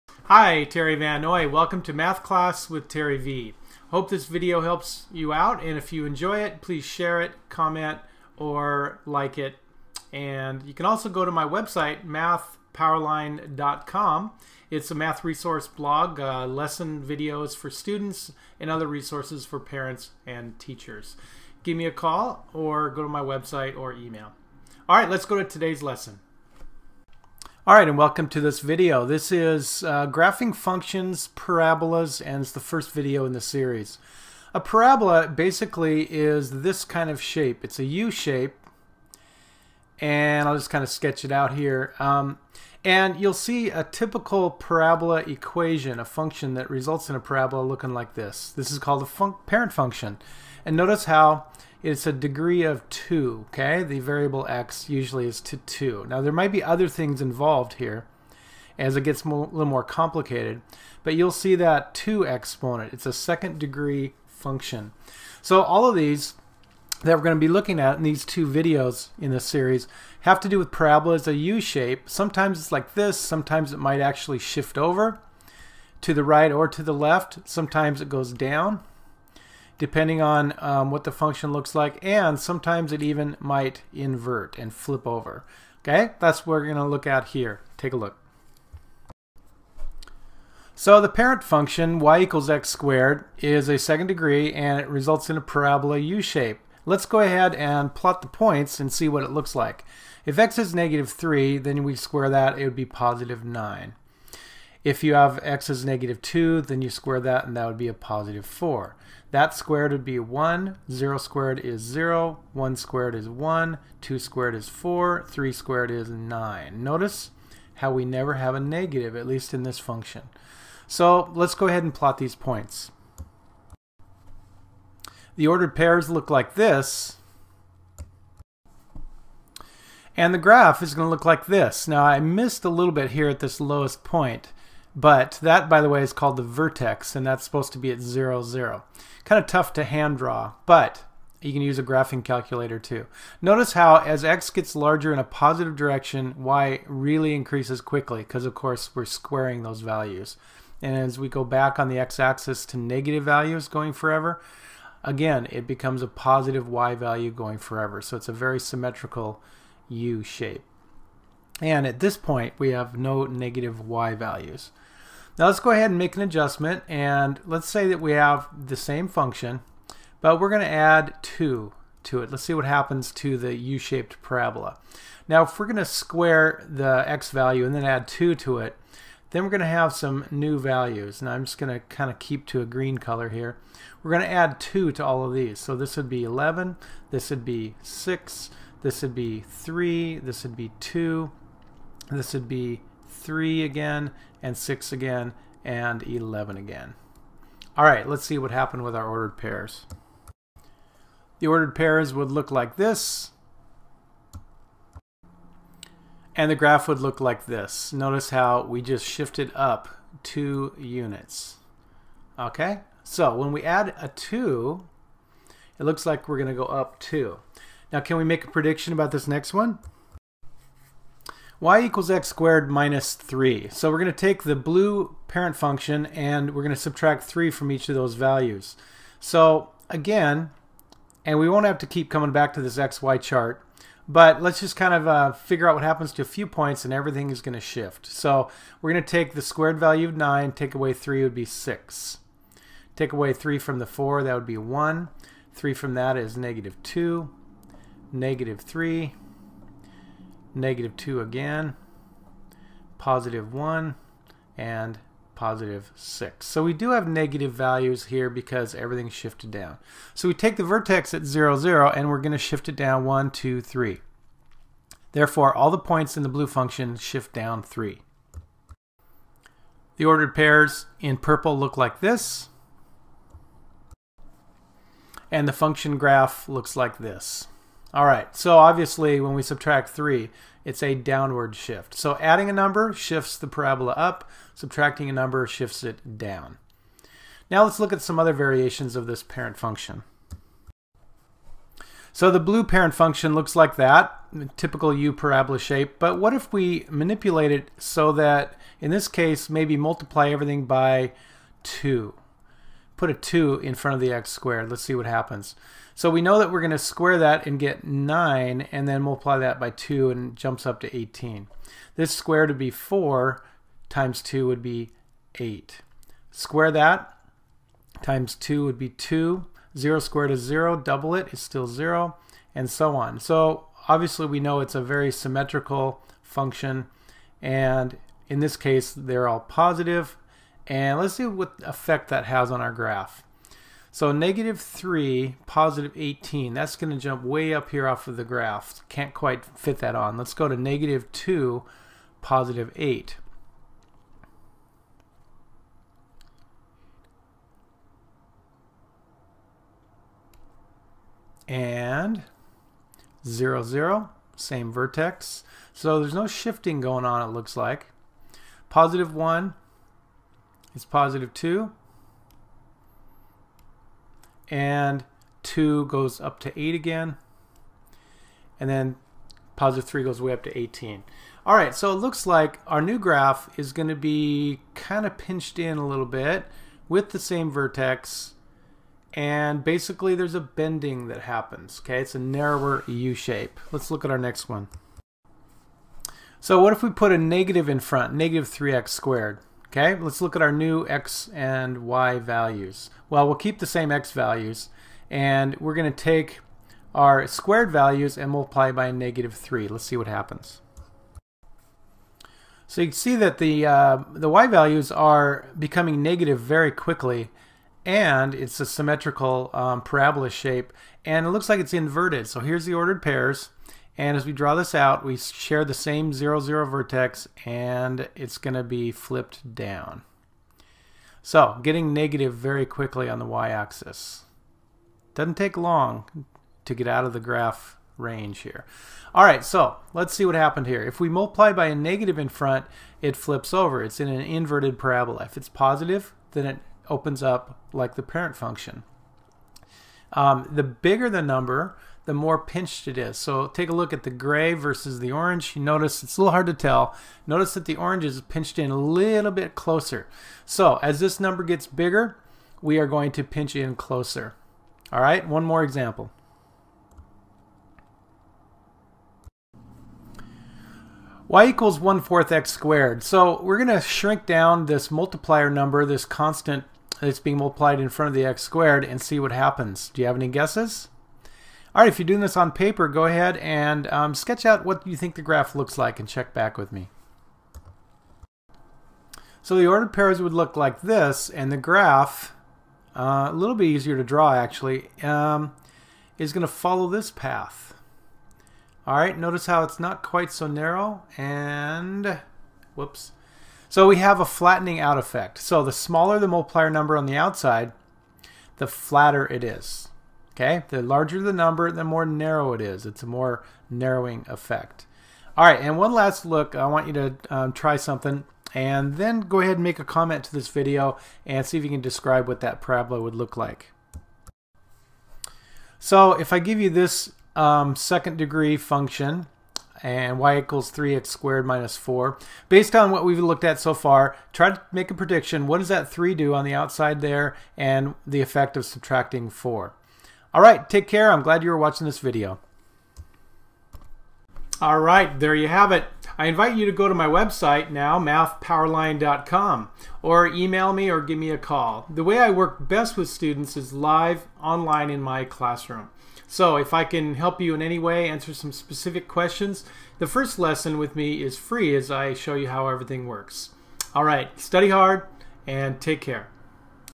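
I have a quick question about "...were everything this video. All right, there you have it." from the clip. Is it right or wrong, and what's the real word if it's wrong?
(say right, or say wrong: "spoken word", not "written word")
wrong: "watching", not "everything".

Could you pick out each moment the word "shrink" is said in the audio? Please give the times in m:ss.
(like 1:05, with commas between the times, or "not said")
7:43.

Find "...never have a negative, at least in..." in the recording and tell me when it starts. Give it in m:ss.
1:58.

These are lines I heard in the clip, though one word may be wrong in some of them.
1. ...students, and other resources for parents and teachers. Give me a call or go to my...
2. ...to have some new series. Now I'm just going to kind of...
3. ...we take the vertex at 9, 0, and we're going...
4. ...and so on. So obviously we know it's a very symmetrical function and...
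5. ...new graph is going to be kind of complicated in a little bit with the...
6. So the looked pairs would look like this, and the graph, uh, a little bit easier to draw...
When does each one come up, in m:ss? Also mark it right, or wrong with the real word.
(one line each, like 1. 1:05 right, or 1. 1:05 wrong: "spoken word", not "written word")
1. 0:17 right
2. 2:59 wrong: "values", not "series"
3. 4:20 wrong: "0", not "9"
4. 5:22 right
5. 6:12 wrong: "pinched", not "complicated"
6. 7:59 wrong: "ordered", not "looked".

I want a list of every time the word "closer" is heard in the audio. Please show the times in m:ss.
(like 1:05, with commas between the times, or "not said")
7:29, 7:33.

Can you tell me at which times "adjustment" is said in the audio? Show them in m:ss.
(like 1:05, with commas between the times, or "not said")
2:46.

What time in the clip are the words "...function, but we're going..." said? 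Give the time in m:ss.
2:49.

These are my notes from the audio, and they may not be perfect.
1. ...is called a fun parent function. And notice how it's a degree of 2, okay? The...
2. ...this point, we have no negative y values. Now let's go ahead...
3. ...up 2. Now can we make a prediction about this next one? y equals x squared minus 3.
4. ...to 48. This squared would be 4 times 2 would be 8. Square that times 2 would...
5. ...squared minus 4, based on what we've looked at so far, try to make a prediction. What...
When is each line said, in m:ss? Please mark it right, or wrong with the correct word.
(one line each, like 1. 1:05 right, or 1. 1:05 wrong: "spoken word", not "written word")
1. 0:48 right
2. 2:41 right
3. 3:36 right
4. 5:10 wrong: "18", not "48"
5. 8:41 right.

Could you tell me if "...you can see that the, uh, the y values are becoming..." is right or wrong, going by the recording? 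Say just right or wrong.
right.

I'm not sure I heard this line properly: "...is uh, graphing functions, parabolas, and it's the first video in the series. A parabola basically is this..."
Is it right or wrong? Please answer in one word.
right.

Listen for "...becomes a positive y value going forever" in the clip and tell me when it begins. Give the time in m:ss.
2:35.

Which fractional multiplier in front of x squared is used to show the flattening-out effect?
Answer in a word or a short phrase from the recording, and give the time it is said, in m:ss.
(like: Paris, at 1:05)
1/4, at 7:41.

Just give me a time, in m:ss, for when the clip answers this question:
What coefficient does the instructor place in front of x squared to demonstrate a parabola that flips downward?
6:28.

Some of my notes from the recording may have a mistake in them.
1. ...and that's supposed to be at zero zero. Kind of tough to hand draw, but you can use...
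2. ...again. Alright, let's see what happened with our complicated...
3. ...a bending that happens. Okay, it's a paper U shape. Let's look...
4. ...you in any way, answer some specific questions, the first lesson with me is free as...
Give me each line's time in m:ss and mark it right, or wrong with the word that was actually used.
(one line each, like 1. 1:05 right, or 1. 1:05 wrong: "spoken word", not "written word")
1. 2:17 right
2. 3:16 wrong: "ordered", not "complicated"
3. 6:20 wrong: "narrower", not "paper"
4. 9:07 right.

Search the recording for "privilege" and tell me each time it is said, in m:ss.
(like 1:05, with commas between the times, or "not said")
not said.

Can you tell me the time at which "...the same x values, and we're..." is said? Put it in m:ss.
6:33.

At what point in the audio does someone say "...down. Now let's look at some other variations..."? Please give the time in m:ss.
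4:46.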